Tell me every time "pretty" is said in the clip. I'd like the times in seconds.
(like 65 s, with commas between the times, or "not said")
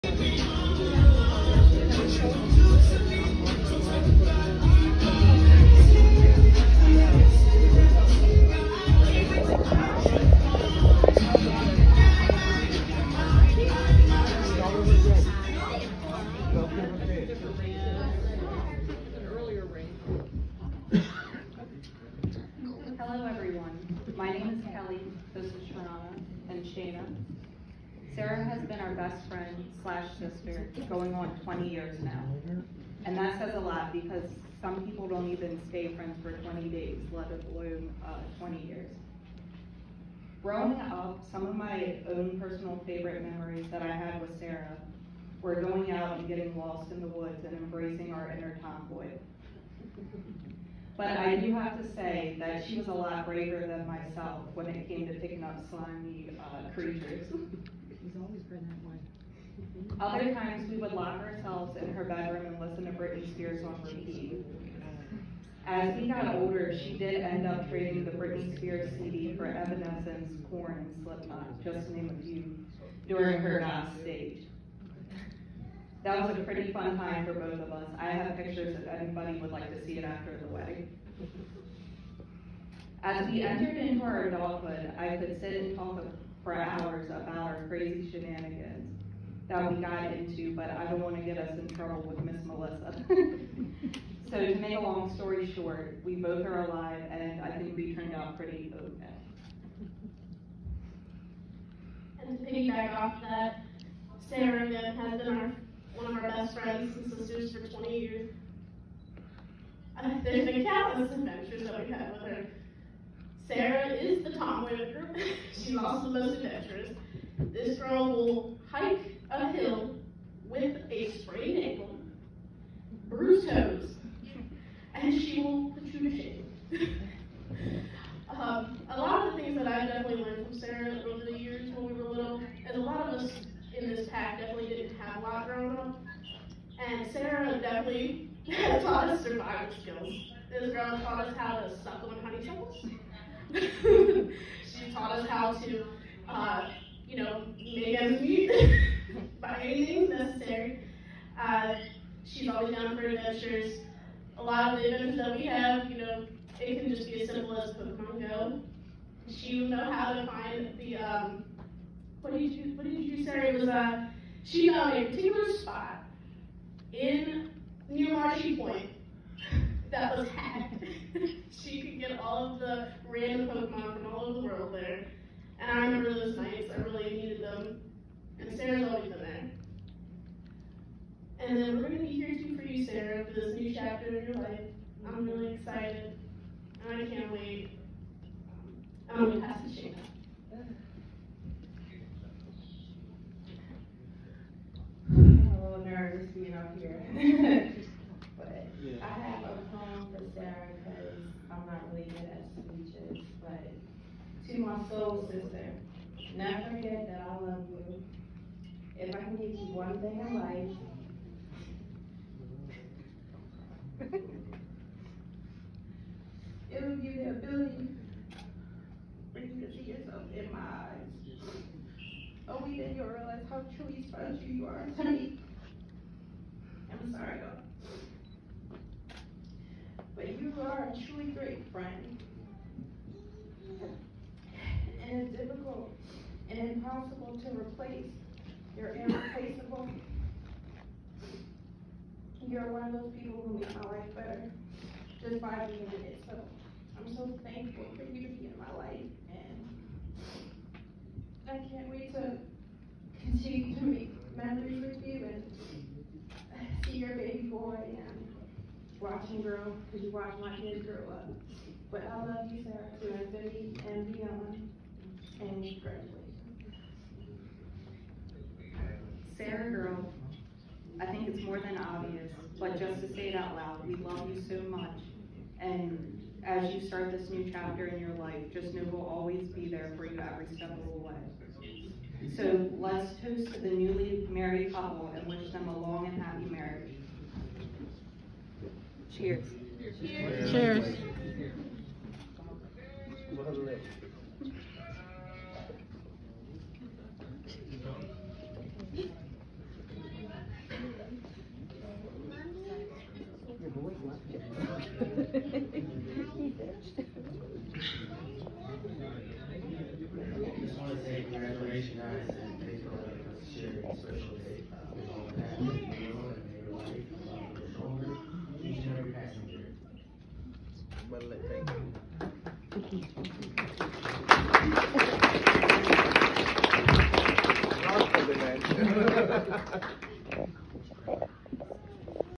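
76 s, 98 s.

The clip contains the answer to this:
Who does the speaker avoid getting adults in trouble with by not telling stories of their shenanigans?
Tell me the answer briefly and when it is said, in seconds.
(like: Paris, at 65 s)
Miss Melissa, at 92 s.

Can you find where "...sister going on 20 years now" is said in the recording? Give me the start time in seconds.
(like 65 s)
30 s.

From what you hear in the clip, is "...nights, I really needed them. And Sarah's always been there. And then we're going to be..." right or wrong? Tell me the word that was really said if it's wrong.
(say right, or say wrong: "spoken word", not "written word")
right.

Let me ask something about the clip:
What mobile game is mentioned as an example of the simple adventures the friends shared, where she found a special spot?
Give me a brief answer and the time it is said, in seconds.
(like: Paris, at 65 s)
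Pokemon Go, at 157 s.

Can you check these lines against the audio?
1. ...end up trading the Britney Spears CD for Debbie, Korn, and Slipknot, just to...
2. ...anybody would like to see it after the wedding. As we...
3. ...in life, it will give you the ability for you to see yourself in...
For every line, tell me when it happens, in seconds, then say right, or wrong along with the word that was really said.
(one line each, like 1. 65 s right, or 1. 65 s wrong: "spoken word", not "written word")
1. 67 s wrong: "Evanescence", not "Debbie"
2. 78 s right
3. 210 s right.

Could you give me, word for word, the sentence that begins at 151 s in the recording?
Uh, she's always down for adventures.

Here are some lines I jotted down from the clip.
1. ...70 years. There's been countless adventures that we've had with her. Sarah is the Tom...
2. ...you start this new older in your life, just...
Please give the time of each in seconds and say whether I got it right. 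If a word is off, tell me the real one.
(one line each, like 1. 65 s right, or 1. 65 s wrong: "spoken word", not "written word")
1. 107 s wrong: "20", not "70"
2. 276 s wrong: "chapter", not "older".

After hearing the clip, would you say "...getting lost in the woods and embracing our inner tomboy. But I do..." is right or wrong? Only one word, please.
right.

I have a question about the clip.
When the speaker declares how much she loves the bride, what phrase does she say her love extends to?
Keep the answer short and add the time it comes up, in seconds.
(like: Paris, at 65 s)
infinity and beyond, at 263 s.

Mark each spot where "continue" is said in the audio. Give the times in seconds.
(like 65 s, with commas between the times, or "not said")
253 s.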